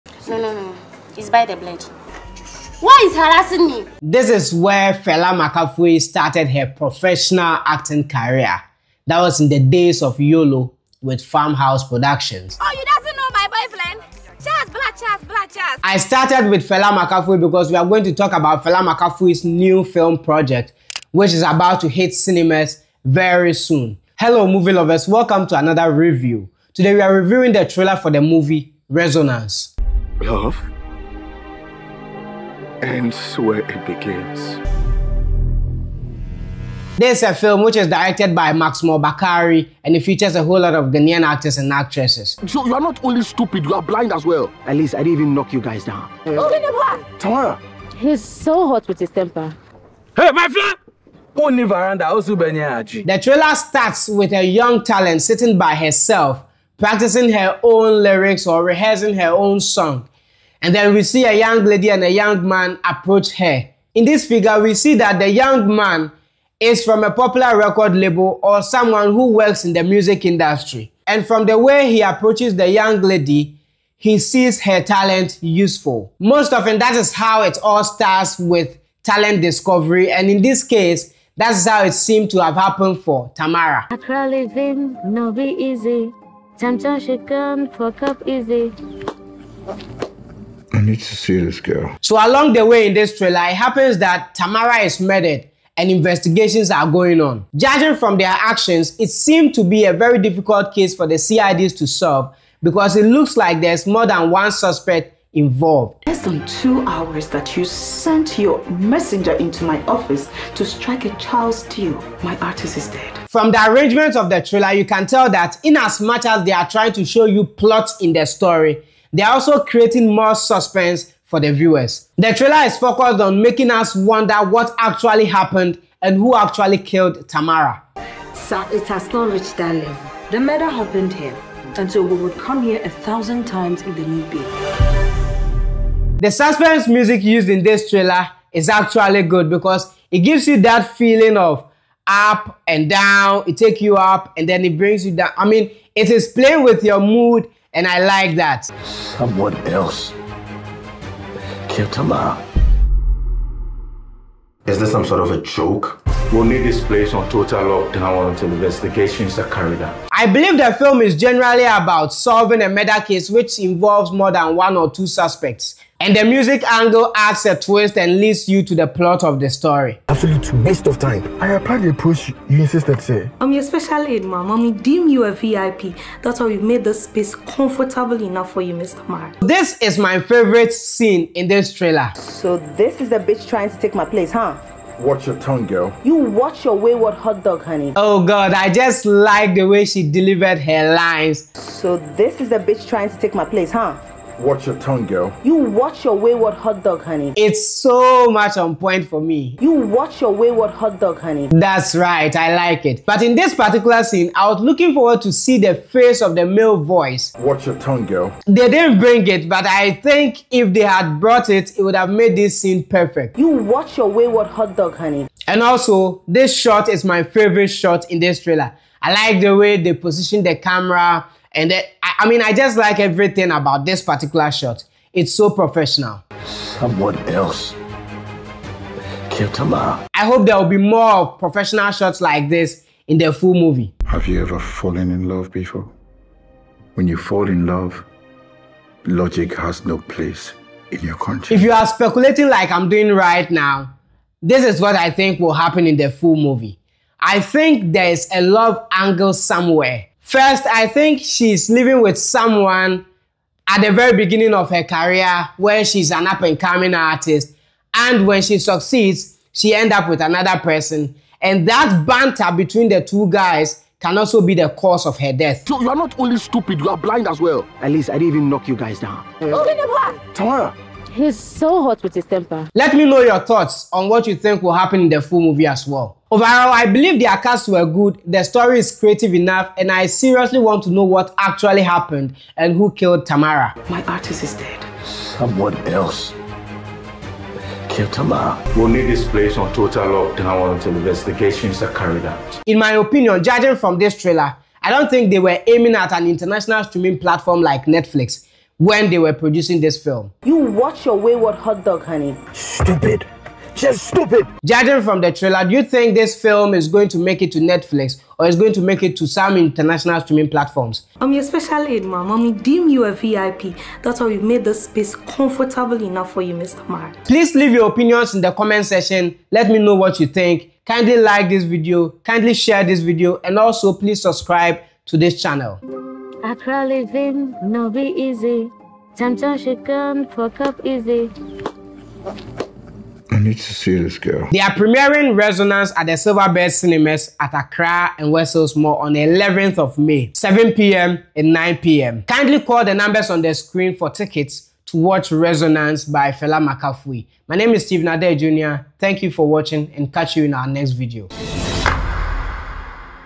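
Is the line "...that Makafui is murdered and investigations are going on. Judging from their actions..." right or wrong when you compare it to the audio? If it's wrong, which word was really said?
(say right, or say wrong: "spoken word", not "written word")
wrong: "Tamara", not "Makafui".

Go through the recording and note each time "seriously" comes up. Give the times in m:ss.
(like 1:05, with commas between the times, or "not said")
4:40.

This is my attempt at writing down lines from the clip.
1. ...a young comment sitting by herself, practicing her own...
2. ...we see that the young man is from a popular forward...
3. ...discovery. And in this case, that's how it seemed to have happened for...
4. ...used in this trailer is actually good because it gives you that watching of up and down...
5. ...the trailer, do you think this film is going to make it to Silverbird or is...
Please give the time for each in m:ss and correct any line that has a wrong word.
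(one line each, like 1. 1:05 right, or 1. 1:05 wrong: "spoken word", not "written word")
1. 0:54 wrong: "talent", not "comment"
2. 1:04 wrong: "record", not "forward"
3. 1:19 right
4. 2:17 wrong: "feeling", not "watching"
5. 5:05 wrong: "Netflix", not "Silverbird".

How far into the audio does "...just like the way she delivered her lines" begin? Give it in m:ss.
3:08.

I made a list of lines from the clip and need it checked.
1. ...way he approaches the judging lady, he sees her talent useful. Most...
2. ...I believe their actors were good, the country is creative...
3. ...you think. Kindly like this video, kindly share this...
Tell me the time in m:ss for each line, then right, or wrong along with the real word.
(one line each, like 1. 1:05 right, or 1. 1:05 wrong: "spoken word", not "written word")
1. 1:11 wrong: "young", not "judging"
2. 4:36 wrong: "story", not "country"
3. 5:20 right.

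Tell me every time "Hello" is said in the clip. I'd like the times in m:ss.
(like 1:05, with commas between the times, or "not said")
0:24.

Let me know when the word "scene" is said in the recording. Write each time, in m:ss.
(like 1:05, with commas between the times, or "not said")
3:00, 3:24, 3:32.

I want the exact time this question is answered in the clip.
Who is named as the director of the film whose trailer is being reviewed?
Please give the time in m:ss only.
0:38.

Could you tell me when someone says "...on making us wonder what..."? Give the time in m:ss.
2:03.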